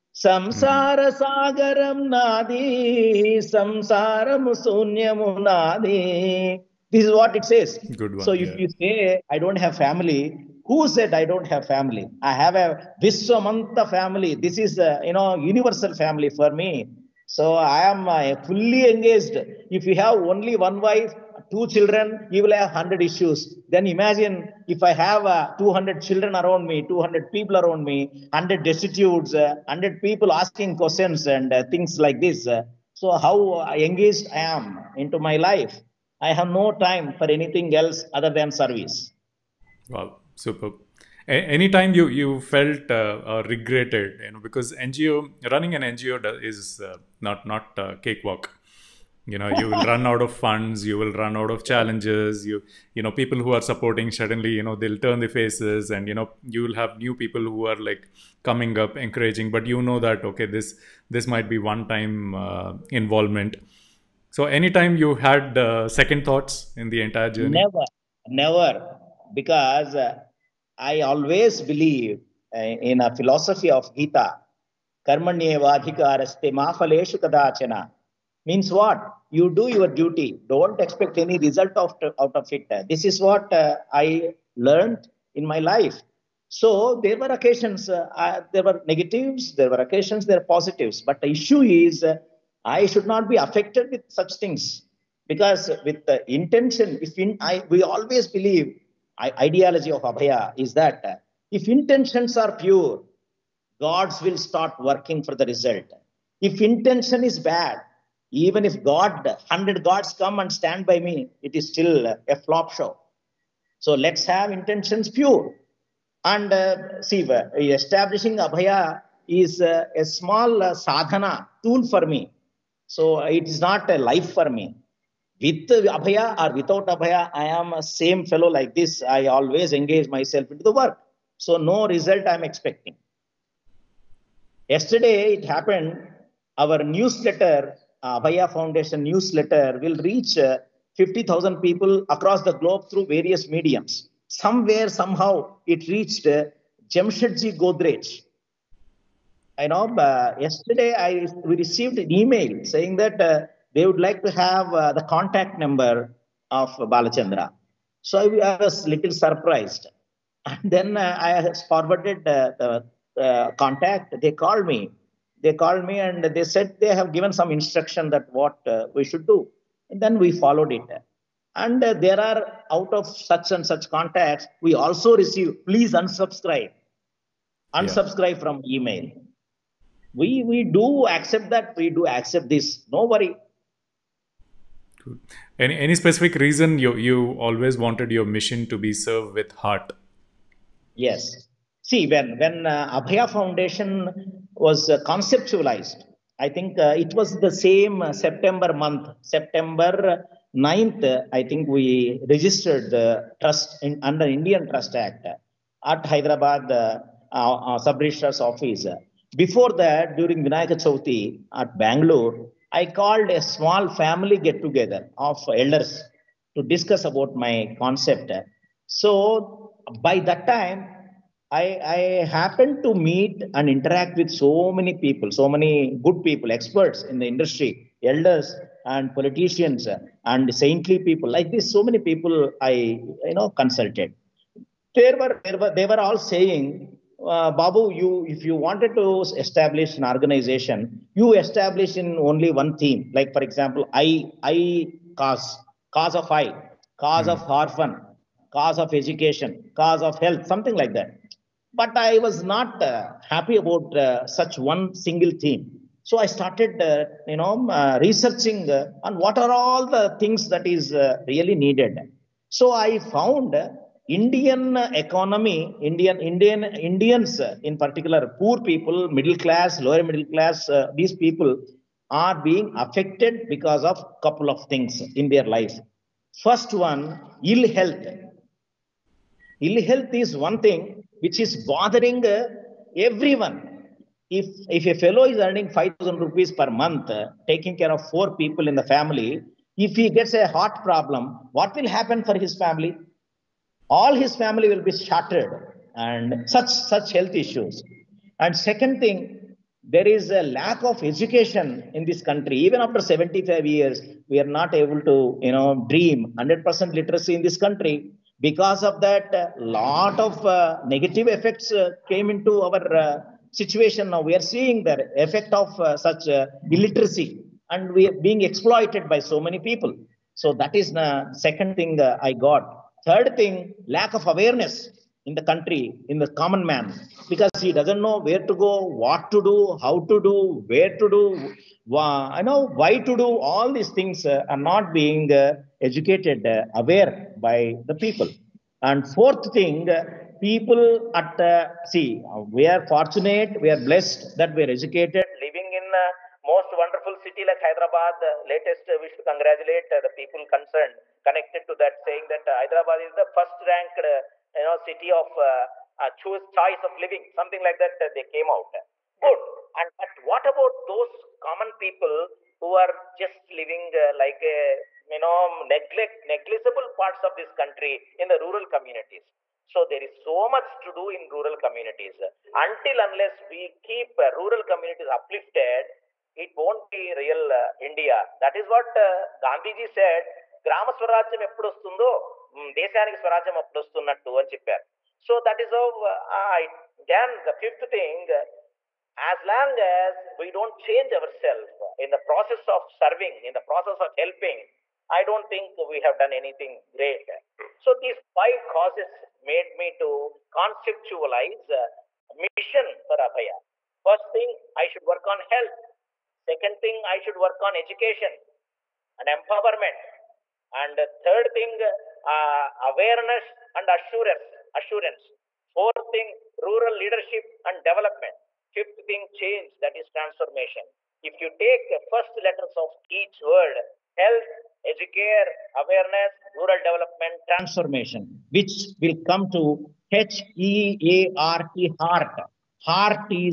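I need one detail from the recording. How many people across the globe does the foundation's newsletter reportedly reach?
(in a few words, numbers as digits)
50,000.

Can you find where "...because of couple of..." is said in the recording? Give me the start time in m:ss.
4:33.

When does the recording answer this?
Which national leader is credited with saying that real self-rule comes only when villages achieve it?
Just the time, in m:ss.
6:19.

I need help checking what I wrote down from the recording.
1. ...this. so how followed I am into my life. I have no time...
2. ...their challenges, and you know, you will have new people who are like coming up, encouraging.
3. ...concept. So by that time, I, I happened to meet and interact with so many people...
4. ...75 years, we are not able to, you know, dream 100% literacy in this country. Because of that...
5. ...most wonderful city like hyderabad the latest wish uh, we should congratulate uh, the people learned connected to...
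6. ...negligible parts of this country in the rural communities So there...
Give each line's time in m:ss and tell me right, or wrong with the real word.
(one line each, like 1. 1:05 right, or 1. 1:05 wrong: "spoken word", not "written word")
1. 0:32 wrong: "engaged", not "followed"
2. 0:55 wrong: "faces", not "challenges"
3. 3:37 right
4. 5:03 right
5. 5:46 wrong: "concerned", not "learned"
6. 6:06 right.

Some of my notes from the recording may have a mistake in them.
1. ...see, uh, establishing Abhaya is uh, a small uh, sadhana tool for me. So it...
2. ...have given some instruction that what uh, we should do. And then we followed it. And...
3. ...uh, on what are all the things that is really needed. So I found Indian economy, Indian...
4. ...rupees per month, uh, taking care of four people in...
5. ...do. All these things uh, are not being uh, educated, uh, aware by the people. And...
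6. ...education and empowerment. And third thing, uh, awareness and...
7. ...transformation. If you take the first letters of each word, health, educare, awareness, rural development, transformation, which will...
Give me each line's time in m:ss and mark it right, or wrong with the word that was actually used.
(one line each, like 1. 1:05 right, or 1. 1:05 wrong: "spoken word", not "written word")
1. 1:57 right
2. 2:46 right
3. 4:18 right
4. 4:46 right
5. 5:33 right
6. 6:47 right
7. 7:00 right.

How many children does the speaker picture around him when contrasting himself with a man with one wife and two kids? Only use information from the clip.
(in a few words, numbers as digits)
200.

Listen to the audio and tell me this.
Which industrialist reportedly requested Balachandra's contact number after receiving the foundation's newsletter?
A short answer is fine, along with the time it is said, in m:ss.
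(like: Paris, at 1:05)
Jamshedji Godrej, at 2:26.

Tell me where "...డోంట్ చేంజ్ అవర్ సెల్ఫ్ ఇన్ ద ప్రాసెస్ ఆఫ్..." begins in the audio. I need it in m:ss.
6:30.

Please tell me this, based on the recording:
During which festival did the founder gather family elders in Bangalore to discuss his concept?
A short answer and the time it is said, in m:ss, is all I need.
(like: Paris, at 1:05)
Vinayaka Chauthi, at 3:30.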